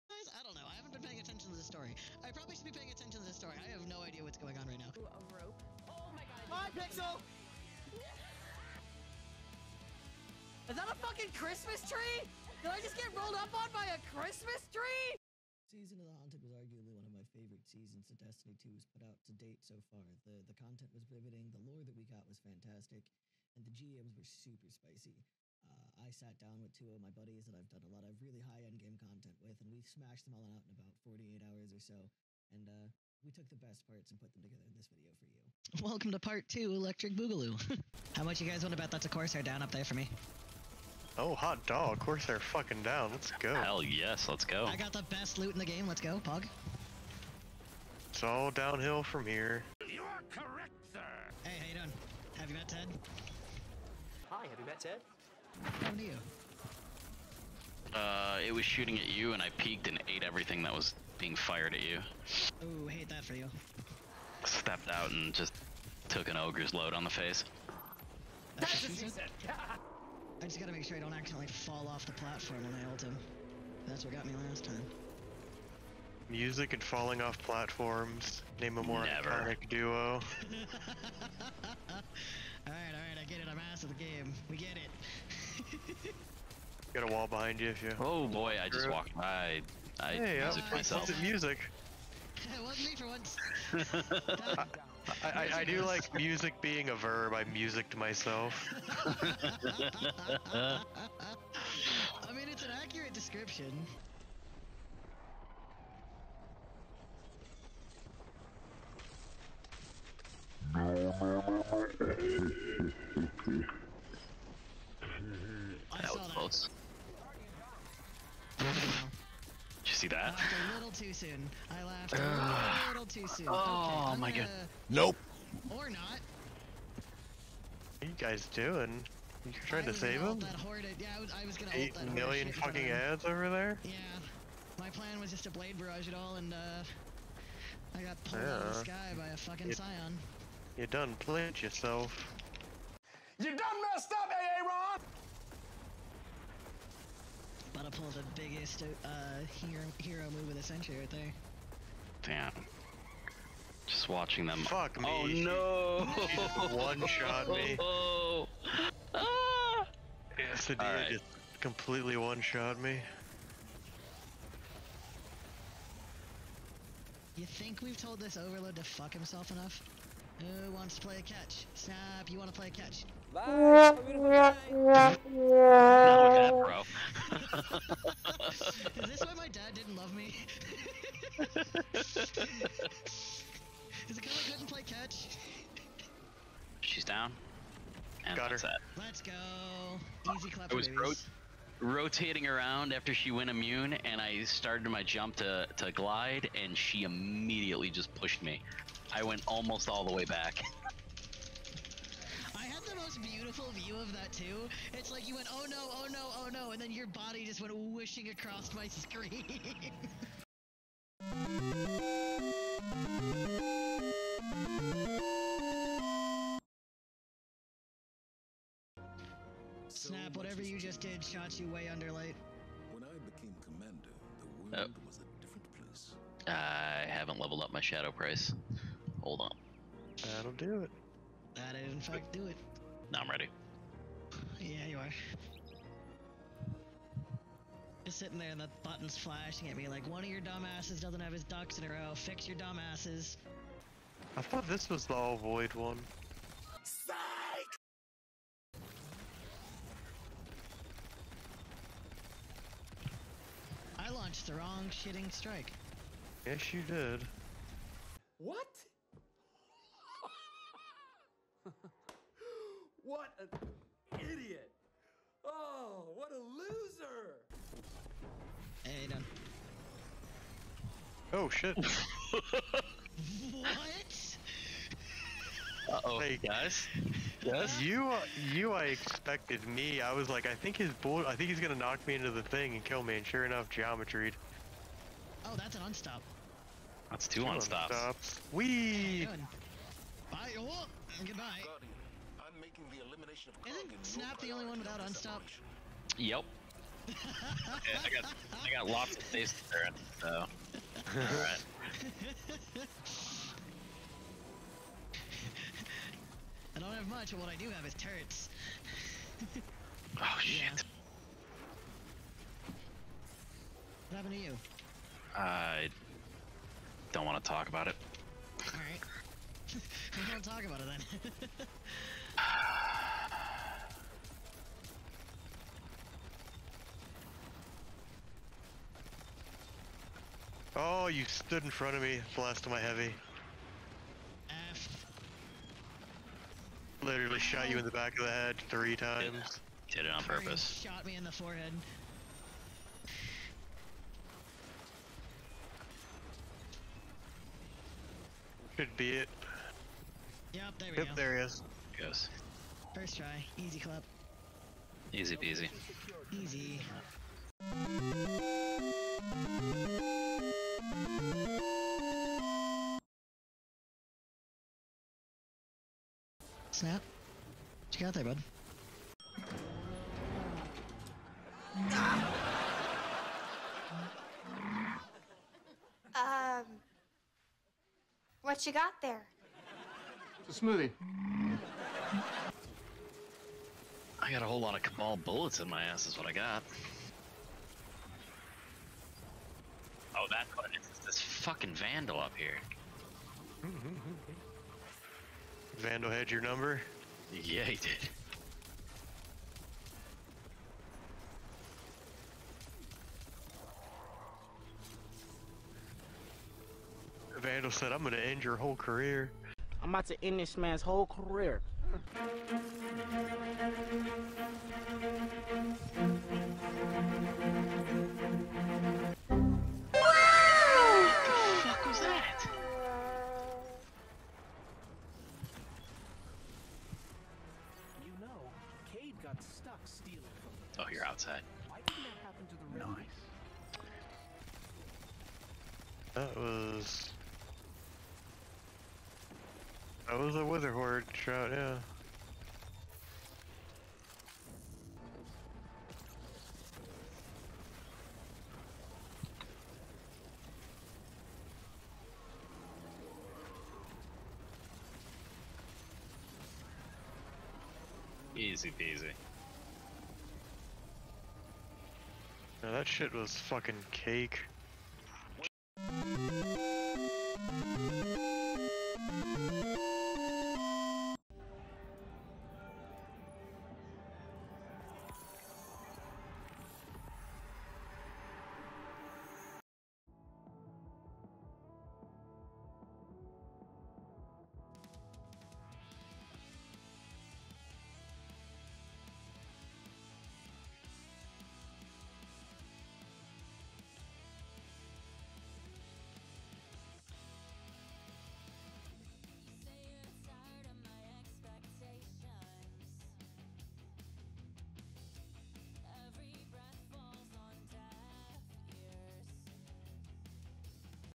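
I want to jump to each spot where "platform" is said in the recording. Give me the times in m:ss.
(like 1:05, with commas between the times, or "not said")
1:12, 1:17.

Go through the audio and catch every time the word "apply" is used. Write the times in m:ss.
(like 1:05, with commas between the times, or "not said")
not said.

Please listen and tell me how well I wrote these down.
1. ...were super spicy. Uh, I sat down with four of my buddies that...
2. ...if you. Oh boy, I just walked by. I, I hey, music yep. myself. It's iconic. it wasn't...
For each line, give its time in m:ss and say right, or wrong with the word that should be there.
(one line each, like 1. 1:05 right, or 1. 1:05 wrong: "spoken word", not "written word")
1. 0:24 wrong: "two", not "four"
2. 1:27 wrong: "music", not "iconic".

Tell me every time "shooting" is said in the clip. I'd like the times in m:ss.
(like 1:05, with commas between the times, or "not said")
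0:58.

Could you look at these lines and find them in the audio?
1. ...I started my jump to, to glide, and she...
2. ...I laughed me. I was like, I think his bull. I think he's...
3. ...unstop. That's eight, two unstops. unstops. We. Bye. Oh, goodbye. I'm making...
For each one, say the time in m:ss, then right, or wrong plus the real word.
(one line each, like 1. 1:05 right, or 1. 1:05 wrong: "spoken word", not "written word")
1. 3:14 right
2. 4:38 wrong: "expected", not "laughed"
3. 4:45 wrong: "two", not "eight".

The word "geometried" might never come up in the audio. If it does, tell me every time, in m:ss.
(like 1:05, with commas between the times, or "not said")
4:43.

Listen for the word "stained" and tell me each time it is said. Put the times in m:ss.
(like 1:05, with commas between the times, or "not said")
not said.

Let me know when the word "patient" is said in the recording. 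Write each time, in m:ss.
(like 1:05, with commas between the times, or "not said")
not said.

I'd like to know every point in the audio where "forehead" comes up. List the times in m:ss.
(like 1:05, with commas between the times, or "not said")
5:41.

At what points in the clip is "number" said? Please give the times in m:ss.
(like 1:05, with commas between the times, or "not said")
6:36.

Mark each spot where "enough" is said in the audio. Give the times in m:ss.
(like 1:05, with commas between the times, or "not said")
2:49, 4:43.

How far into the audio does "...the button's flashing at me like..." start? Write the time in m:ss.
3:58.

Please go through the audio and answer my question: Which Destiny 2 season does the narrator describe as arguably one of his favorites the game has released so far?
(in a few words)
Season of the Haunted.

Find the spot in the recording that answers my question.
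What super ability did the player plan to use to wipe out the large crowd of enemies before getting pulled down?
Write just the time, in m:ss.
2:15.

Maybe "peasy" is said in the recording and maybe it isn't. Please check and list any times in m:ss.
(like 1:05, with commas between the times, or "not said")
5:55, 7:38.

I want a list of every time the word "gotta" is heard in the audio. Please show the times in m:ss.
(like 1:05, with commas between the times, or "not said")
1:10.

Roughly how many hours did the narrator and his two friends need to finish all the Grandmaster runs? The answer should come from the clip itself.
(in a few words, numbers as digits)
48.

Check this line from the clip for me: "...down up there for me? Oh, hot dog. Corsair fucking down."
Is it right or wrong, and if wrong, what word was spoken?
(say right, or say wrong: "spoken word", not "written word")
right.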